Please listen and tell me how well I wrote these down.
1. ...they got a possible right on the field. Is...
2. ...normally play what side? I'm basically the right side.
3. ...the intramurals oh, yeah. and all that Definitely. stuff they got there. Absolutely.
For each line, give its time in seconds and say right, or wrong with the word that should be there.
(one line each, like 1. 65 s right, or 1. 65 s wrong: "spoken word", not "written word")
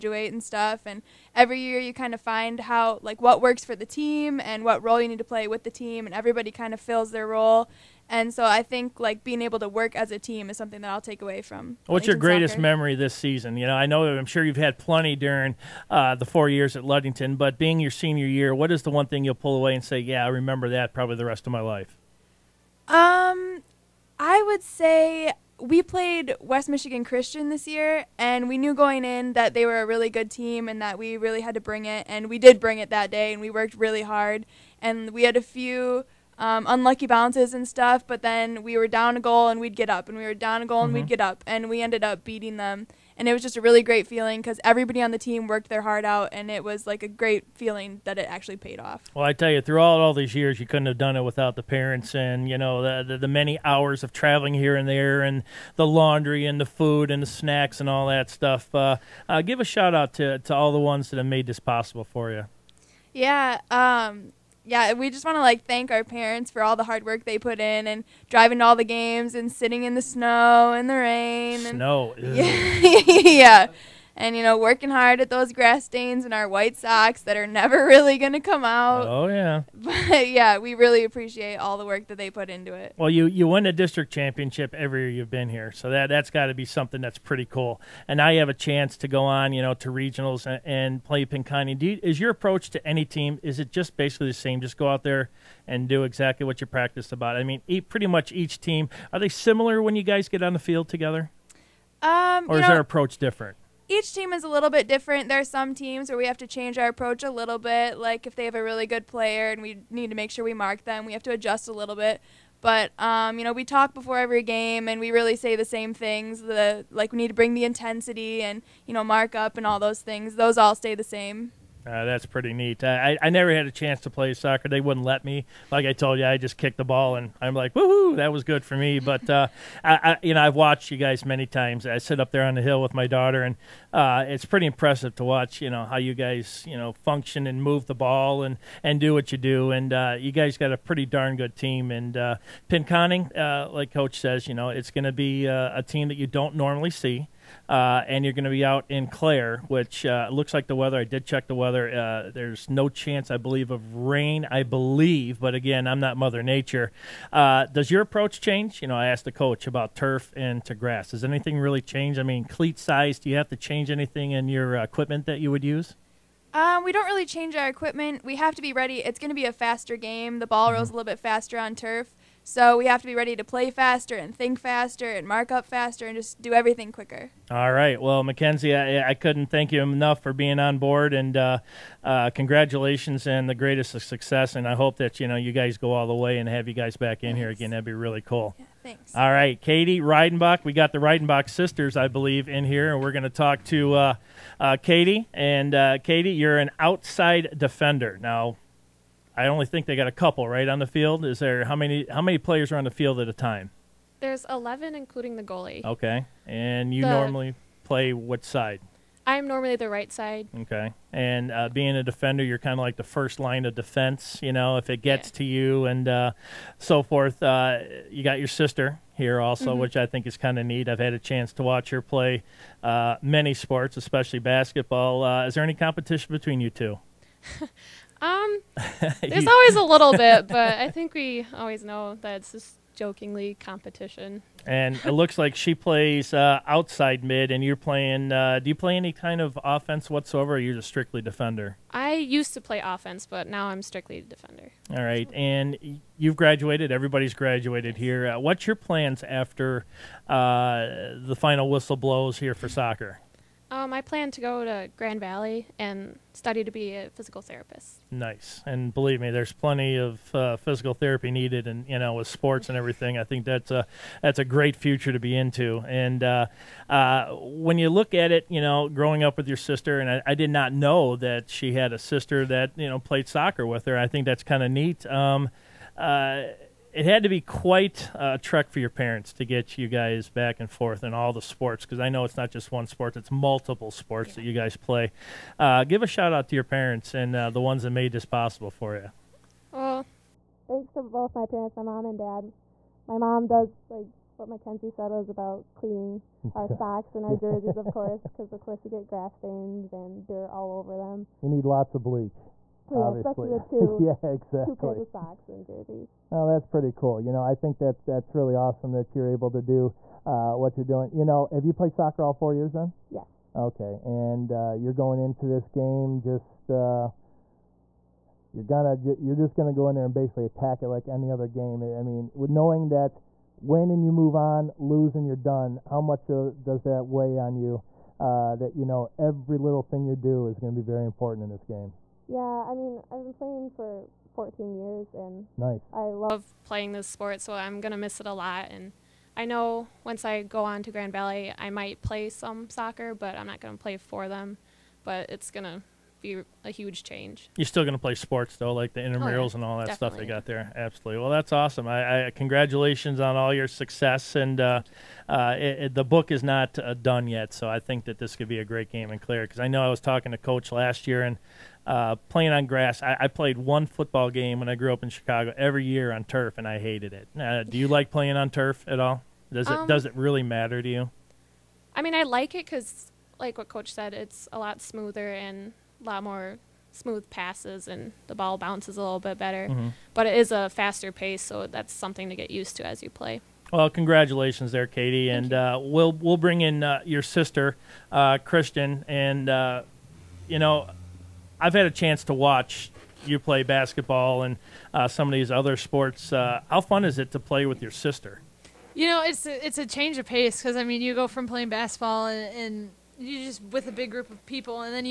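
1. 199 s wrong: "couple", not "possible"
2. 207 s wrong: "normally", not "basically"
3. 348 s right.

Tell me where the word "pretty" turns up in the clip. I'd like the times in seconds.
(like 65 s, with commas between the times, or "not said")
87 s, 97 s, 122 s, 134 s, 140 s, 306 s.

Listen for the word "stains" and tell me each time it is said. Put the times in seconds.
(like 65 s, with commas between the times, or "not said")
75 s, 299 s.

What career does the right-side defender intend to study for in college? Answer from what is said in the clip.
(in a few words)
physical therapist.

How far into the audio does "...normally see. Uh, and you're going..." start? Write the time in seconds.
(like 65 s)
146 s.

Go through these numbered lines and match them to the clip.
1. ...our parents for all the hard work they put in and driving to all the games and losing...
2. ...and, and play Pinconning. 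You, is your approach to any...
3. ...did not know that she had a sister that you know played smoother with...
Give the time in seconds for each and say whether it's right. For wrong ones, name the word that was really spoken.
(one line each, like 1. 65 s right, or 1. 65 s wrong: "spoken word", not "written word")
1. 65 s wrong: "sitting", not "losing"
2. 90 s right
3. 270 s wrong: "soccer", not "smoother".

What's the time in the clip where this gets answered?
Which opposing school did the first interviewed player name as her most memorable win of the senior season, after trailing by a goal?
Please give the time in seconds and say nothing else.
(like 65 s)
26 s.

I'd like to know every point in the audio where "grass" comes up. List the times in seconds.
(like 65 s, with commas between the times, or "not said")
75 s, 160 s, 299 s, 362 s.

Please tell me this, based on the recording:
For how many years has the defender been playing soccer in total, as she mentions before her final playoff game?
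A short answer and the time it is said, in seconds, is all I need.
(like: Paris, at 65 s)
14, at 334 s.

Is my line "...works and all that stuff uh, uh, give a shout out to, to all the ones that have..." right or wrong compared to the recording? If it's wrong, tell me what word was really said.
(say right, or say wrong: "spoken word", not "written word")
wrong: "snacks", not "works".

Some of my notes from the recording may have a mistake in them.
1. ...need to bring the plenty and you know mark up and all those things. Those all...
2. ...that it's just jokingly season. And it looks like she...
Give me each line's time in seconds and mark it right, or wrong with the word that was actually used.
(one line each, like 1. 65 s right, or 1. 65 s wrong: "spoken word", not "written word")
1. 117 s wrong: "intensity", not "plenty"
2. 232 s wrong: "competition", not "season".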